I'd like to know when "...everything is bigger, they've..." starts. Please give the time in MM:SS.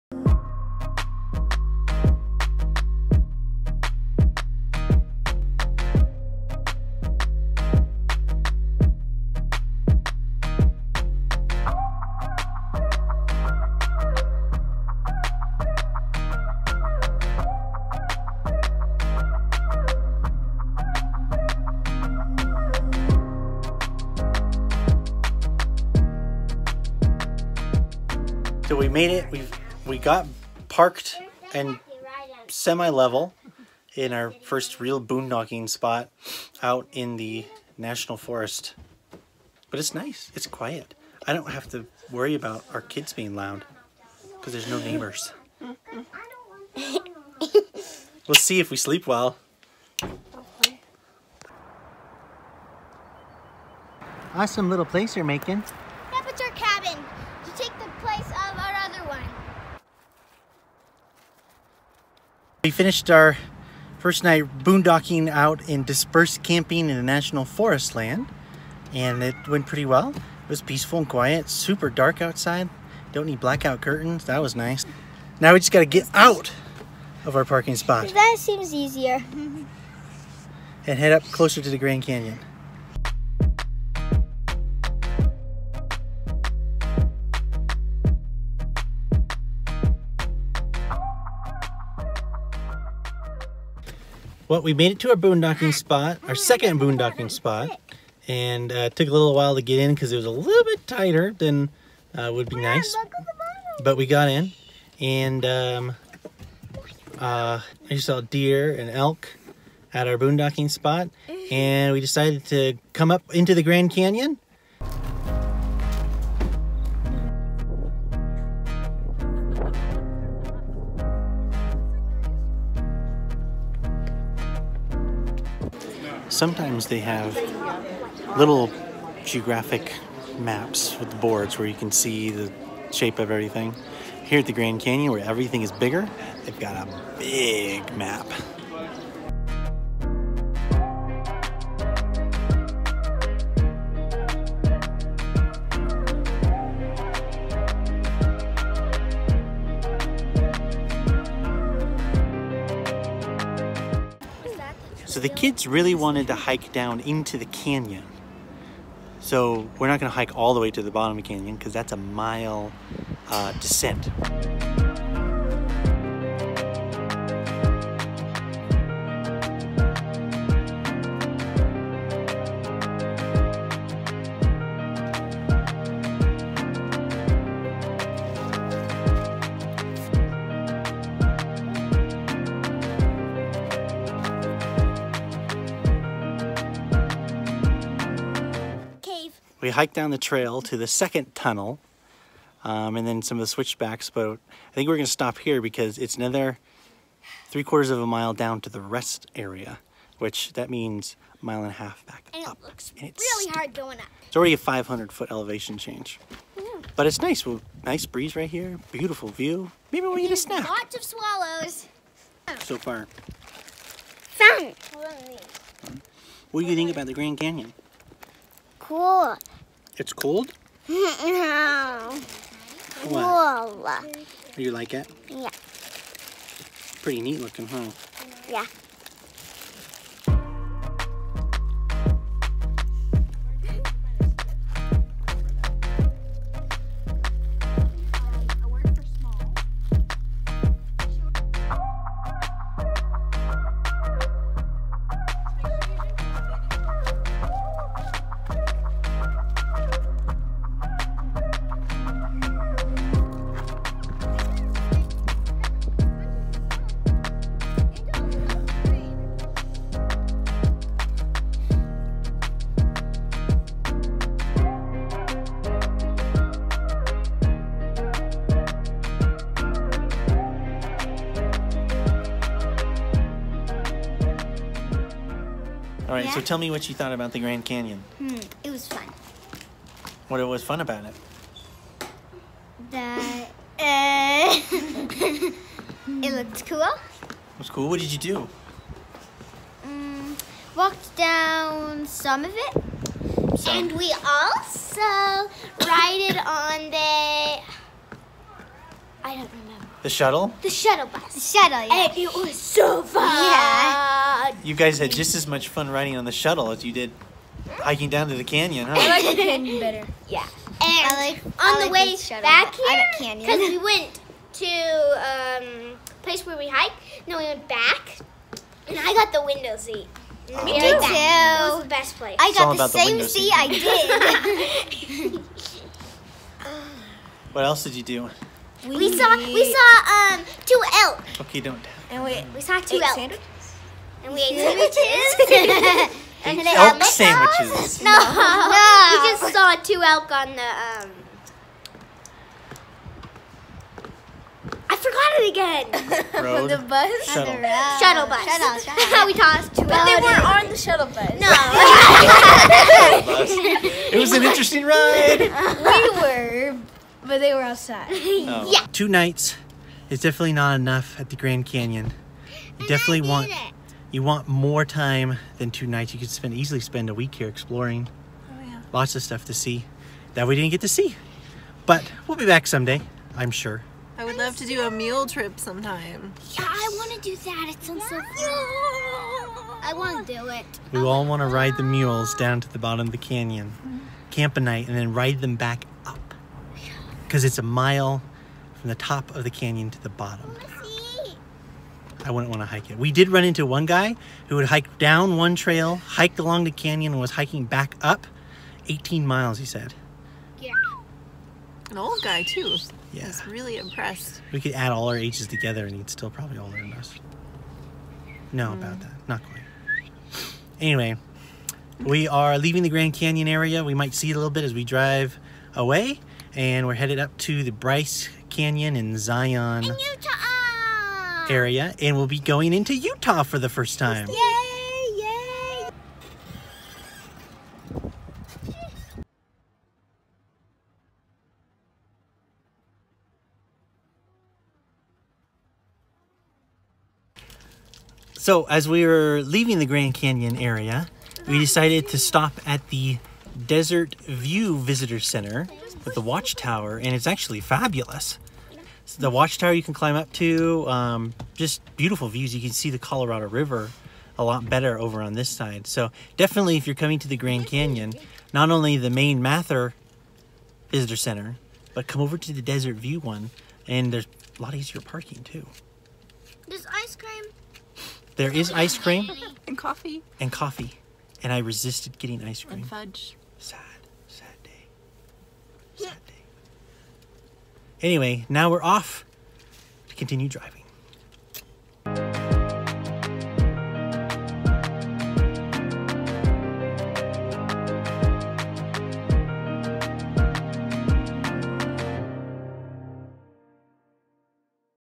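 02:15.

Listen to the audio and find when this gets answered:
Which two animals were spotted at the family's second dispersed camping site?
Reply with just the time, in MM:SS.
01:48.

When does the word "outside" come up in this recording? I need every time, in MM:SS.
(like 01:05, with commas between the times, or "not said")
01:12, 05:57.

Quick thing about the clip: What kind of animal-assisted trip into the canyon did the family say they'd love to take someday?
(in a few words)
A mule trip.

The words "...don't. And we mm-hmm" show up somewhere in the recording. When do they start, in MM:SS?
05:31.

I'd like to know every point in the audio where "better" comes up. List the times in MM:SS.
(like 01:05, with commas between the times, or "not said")
05:09, 07:34.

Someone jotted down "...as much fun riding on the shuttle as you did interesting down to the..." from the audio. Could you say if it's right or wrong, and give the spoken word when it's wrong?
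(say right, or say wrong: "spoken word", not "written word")
wrong: "hiking", not "interesting".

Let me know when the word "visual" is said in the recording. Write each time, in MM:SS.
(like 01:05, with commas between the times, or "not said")
not said.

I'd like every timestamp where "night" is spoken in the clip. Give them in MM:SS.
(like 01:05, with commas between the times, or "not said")
01:04, 05:59, 06:05, 06:24.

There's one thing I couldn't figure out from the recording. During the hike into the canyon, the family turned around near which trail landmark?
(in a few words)
The second tunnel.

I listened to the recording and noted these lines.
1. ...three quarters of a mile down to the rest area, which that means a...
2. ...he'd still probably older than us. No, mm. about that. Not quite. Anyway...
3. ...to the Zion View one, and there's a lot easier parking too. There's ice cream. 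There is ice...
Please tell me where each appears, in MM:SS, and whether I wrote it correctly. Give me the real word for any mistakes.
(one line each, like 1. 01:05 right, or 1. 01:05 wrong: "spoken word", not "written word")
1. 03:17 right
2. 06:45 right
3. 07:42 wrong: "Desert", not "Zion".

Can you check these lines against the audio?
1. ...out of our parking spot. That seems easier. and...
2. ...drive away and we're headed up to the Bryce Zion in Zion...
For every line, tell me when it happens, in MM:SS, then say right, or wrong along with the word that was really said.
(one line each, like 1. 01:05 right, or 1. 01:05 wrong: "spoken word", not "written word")
1. 01:16 right
2. 06:54 wrong: "Canyon", not "Zion".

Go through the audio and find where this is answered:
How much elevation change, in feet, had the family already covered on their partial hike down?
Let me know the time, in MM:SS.
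03:24.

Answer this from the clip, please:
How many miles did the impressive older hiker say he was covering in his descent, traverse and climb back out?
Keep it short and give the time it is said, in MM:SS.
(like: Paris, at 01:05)
18 miles, at 06:38.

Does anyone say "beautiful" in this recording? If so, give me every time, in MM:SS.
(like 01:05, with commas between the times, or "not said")
03:28, 07:31.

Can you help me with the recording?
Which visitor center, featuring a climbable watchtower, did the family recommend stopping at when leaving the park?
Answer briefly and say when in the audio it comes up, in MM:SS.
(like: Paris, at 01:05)
Desert View Visitor Center, at 07:23.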